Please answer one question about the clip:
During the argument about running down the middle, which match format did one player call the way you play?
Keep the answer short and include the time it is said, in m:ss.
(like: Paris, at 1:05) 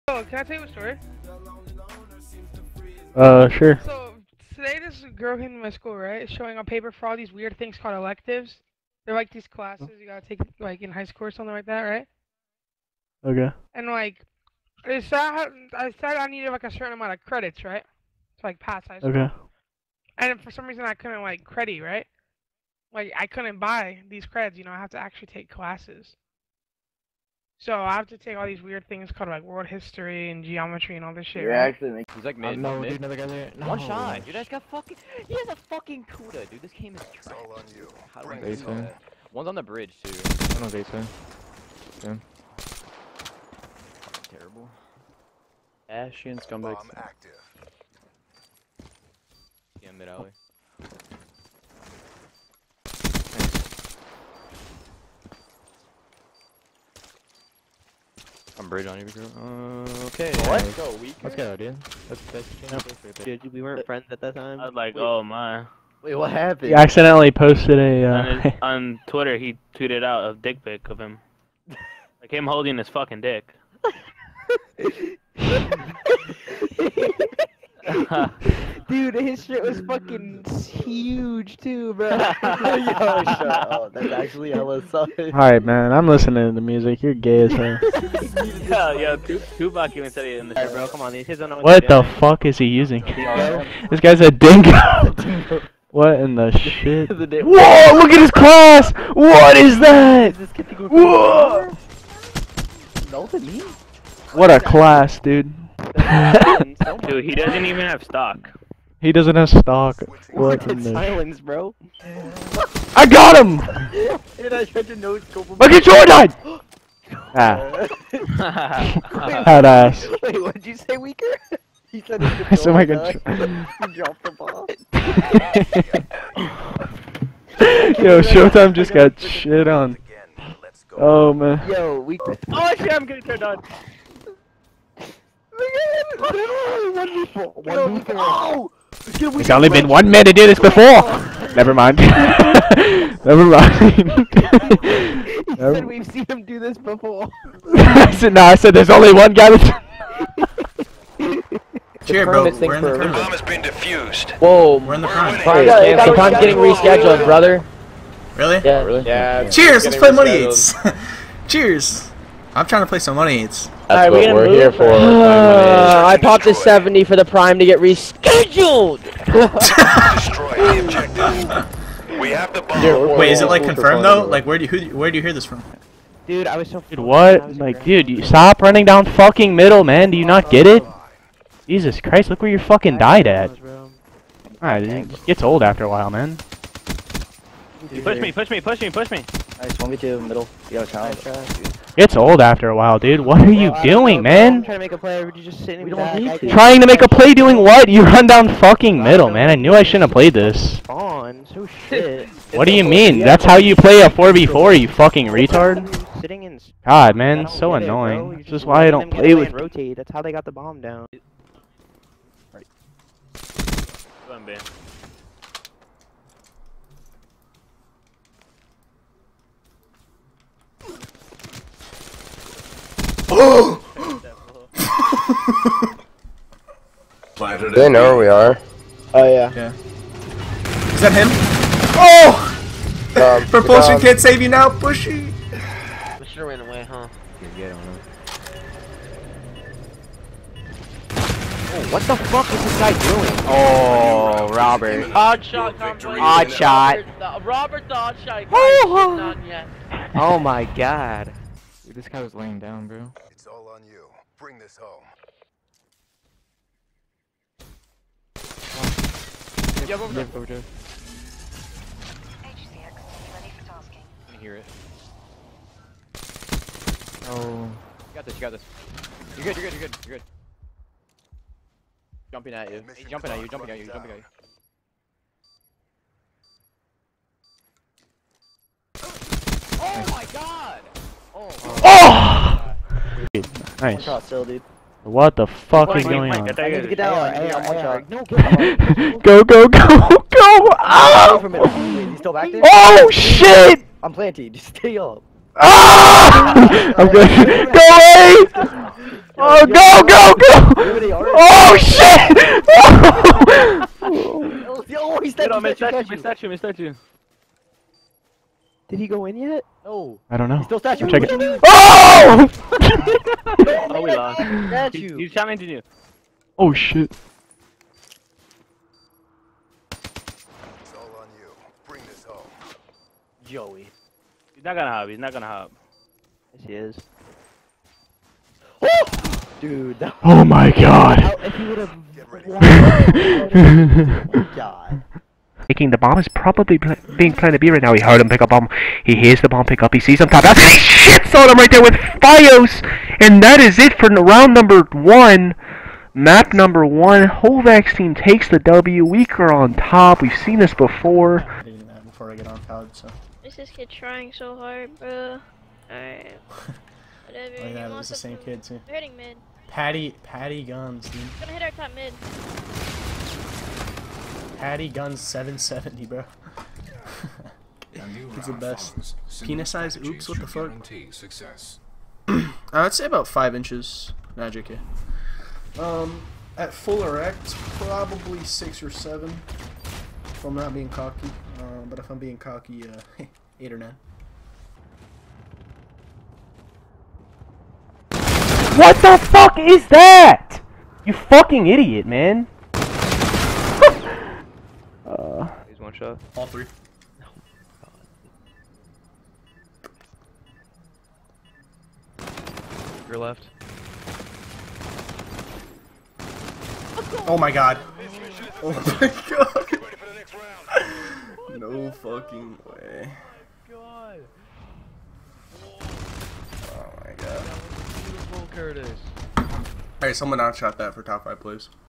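4v4, at 3:24.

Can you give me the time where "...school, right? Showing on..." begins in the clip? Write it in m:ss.
0:05.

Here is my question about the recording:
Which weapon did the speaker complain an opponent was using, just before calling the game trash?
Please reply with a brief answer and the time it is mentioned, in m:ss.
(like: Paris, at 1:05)
Kuda, at 0:36.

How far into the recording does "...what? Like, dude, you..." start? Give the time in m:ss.
2:56.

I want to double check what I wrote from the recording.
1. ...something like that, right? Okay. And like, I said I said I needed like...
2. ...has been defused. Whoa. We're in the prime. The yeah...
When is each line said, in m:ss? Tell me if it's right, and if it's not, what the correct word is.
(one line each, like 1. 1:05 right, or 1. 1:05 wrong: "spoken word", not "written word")
1. 0:11 right
2. 2:33 right.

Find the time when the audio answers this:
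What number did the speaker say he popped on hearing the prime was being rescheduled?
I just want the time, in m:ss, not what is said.
2:46.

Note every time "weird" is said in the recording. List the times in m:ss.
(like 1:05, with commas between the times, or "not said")
0:07, 0:28.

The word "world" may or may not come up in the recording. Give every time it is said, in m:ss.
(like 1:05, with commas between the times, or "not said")
0:29.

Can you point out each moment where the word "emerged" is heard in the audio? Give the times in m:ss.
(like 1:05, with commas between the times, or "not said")
not said.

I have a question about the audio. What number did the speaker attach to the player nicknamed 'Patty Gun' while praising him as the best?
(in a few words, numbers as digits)
770.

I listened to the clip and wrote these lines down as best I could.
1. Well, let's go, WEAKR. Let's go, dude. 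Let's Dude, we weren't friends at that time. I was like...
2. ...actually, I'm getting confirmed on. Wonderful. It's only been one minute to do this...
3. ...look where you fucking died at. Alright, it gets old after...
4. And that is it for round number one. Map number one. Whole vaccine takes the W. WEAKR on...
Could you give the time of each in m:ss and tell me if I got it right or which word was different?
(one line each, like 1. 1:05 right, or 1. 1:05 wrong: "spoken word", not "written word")
1. 1:00 right
2. 2:12 wrong: "turned", not "confirmed"
3. 3:02 right
4. 5:43 right.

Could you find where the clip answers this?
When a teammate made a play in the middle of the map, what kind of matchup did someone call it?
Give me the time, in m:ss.
3:09.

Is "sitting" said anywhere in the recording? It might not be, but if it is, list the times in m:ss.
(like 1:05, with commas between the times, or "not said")
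3:15, 3:26.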